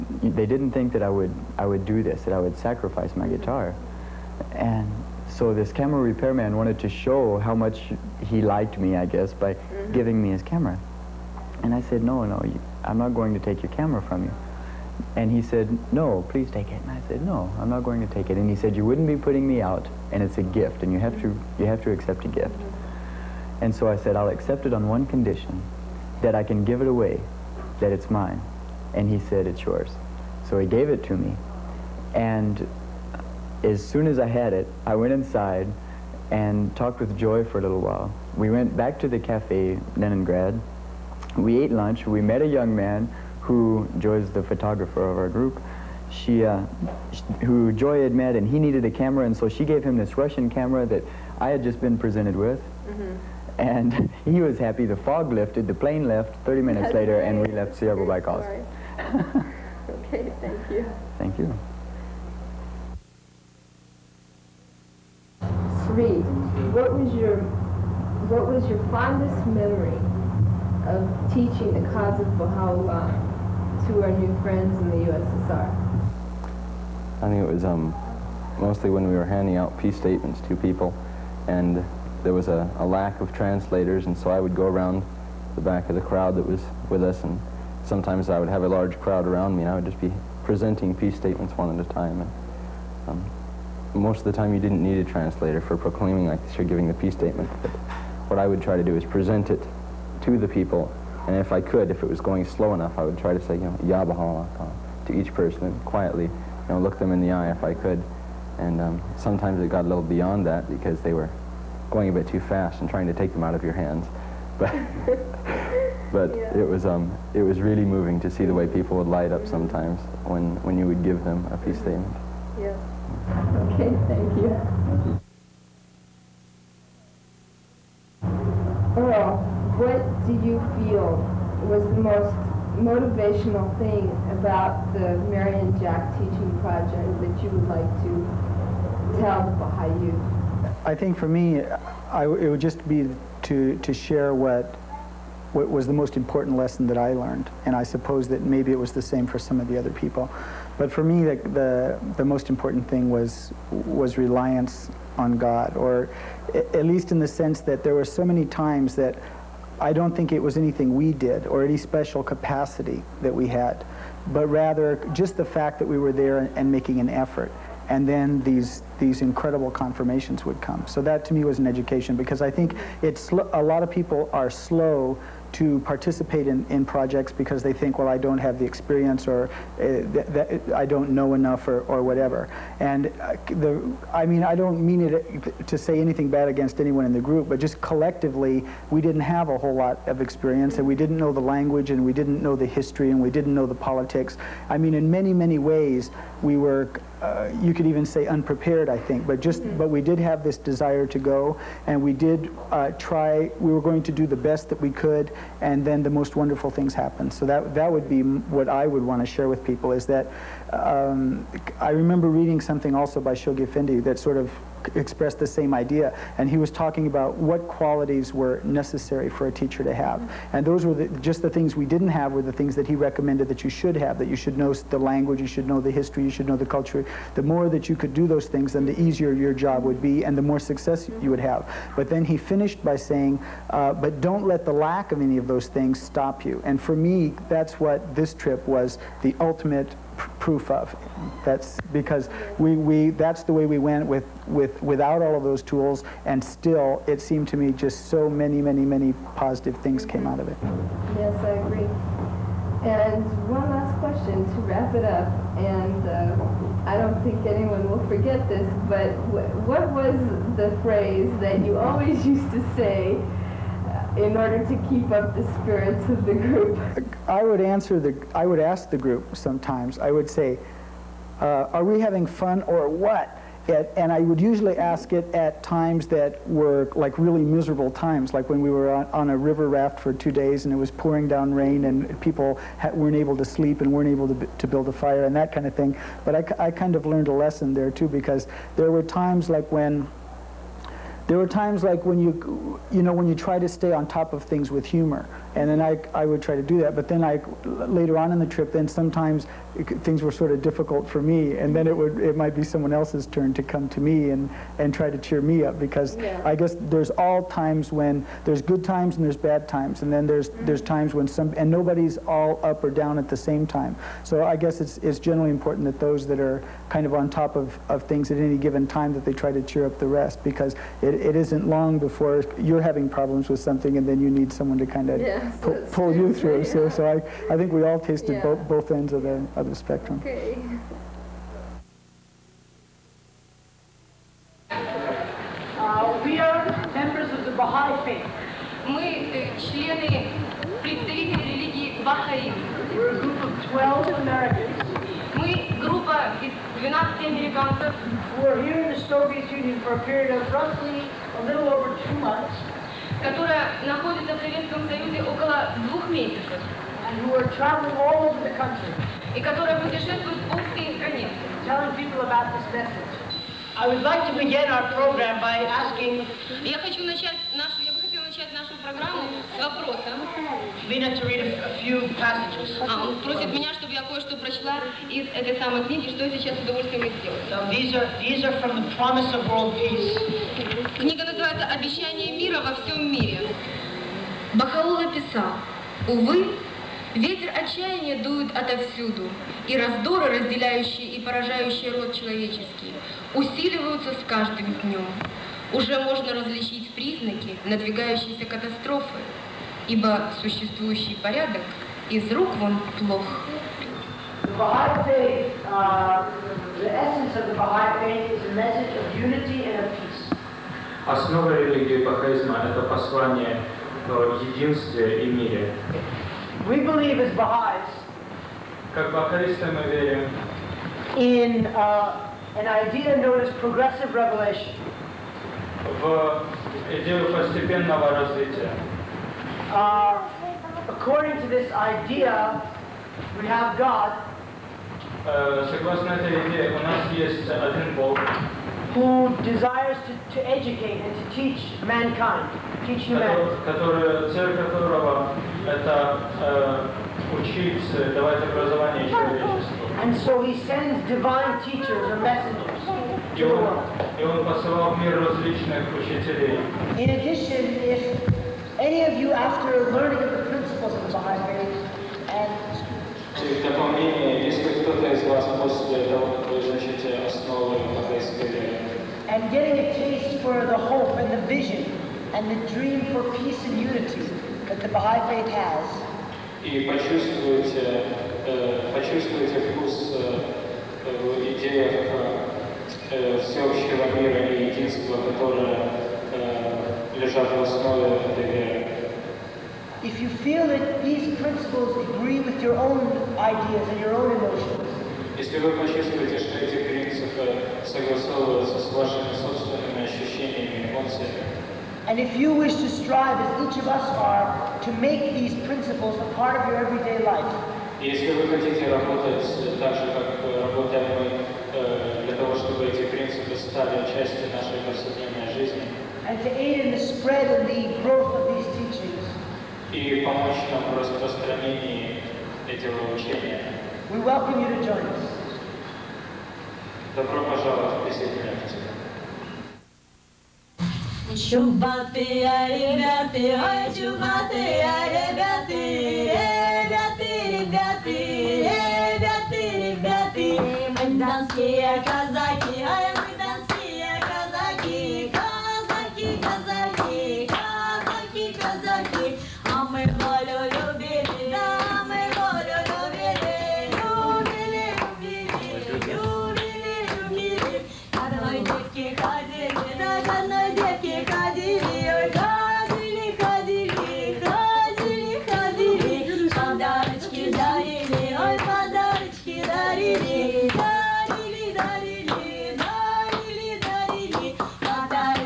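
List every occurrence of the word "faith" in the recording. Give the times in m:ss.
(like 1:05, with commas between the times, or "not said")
6:48, 7:41, 7:55.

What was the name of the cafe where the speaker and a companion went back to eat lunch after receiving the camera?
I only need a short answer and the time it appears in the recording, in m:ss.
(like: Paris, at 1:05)
Leningrad, at 0:39.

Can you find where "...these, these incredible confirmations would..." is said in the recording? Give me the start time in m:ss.
2:48.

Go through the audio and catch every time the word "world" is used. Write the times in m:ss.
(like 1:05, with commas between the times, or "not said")
6:19, 7:33.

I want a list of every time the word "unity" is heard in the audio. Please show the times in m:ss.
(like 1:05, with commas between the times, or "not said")
6:49, 7:53.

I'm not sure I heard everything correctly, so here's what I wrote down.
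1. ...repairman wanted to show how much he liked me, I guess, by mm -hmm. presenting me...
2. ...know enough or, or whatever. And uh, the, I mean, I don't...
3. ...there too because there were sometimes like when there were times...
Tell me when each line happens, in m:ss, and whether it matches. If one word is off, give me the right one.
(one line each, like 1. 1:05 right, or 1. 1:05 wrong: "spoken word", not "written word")
1. 0:05 wrong: "giving", not "presenting"
2. 3:01 right
3. 4:47 wrong: "times", not "sometimes".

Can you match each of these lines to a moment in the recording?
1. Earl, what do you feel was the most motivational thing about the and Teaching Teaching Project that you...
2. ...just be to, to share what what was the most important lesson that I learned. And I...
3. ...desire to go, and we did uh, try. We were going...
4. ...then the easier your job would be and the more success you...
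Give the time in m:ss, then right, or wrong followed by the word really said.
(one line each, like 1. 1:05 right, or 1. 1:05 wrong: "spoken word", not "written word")
1. 2:08 wrong: "Jack", not "Teaching"
2. 2:22 right
3. 3:20 right
4. 3:48 right.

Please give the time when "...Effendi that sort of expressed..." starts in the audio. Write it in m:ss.
3:33.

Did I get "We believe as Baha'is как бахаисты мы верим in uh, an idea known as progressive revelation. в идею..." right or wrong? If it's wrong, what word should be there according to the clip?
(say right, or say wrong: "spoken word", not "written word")
right.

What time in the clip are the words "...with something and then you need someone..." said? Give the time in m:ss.
5:23.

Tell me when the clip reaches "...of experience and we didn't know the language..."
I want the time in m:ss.
3:10.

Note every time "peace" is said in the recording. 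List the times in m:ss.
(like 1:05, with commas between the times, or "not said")
1:19, 1:30, 1:36, 2:01, 6:19, 6:49, 7:53.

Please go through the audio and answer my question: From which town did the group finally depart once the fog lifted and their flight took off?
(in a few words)
Severo-Baikalsk.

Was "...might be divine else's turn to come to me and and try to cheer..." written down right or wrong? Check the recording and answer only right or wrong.
wrong.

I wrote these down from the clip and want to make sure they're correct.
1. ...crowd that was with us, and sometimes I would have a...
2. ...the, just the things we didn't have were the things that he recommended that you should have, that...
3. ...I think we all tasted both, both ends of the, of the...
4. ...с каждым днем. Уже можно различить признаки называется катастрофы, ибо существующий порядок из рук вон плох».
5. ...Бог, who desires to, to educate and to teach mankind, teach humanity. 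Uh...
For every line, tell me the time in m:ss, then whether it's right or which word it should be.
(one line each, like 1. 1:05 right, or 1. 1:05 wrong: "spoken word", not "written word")
1. 1:26 right
2. 3:40 right
3. 5:27 right
4. 6:34 wrong: "надвигающейся", not "называется"
5. 7:17 right.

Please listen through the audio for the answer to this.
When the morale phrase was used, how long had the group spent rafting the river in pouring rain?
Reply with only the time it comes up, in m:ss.
4:40.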